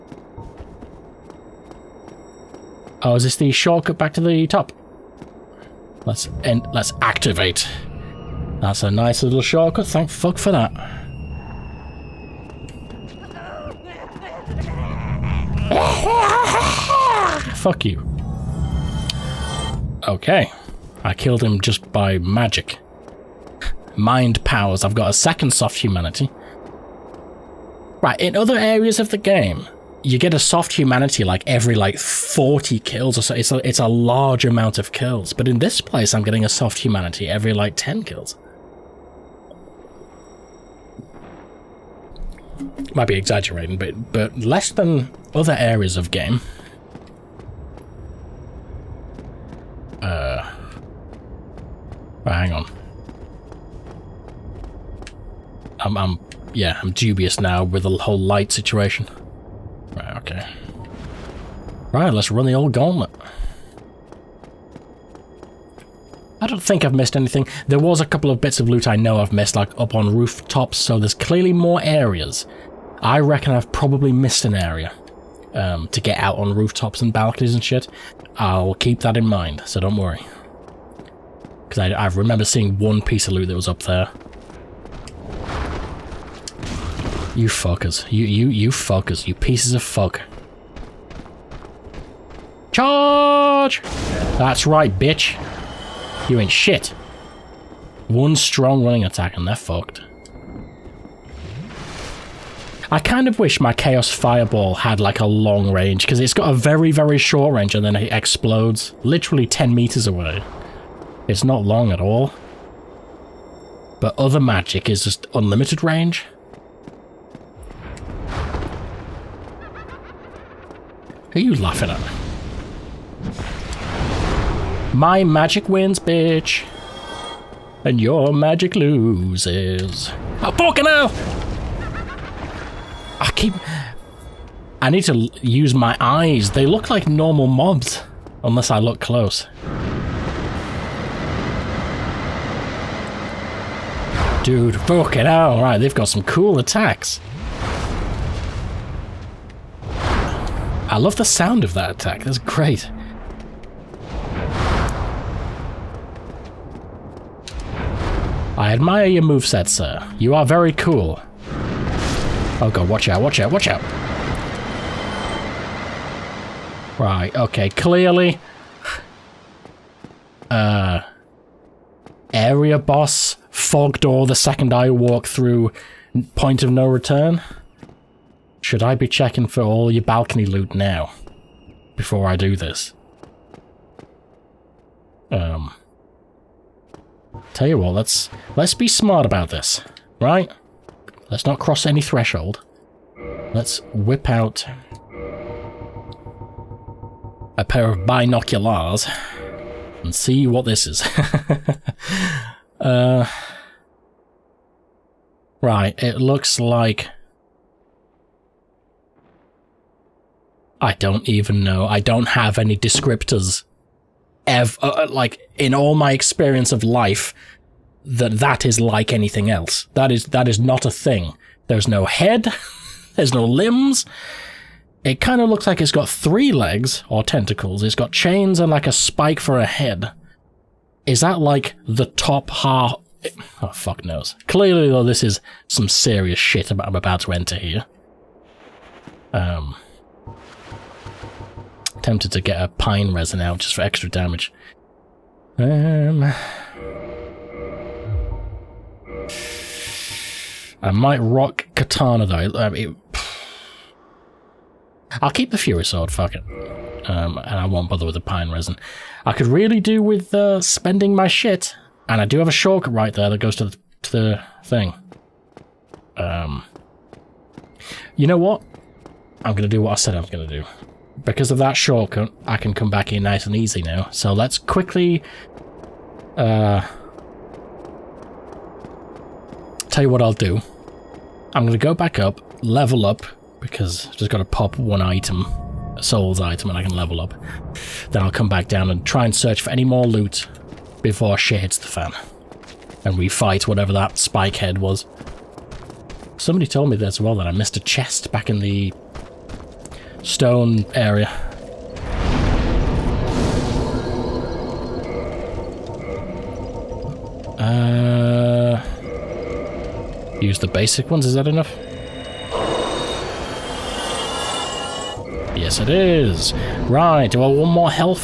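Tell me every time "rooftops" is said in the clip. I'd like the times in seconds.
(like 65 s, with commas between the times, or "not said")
70 s, 76 s.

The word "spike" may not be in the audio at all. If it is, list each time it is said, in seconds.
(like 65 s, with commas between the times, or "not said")
228 s, 294 s.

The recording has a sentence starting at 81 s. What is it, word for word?
Because I, I remember seeing one piece of loot that was up there.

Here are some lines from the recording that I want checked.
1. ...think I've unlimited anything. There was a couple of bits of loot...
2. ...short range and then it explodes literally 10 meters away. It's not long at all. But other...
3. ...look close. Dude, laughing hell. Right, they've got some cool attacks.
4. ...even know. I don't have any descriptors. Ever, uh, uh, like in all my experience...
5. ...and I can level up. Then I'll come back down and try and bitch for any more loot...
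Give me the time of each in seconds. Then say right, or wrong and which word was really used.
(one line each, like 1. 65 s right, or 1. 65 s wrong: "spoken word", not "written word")
1. 66 s wrong: "missed", not "unlimited"
2. 107 s right
3. 138 s wrong: "fucking", not "laughing"
4. 211 s right
5. 286 s wrong: "search", not "bitch".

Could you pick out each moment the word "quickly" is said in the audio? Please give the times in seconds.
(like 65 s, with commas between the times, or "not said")
274 s.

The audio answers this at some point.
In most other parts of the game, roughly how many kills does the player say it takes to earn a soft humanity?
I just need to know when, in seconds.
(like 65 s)
31 s.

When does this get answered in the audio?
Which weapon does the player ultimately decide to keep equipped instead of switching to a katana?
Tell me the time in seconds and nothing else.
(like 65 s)
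255 s.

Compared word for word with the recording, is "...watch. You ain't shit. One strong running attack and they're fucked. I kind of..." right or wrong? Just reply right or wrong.
wrong.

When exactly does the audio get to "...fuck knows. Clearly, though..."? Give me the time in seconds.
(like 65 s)
233 s.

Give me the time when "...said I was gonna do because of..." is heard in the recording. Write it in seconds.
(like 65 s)
269 s.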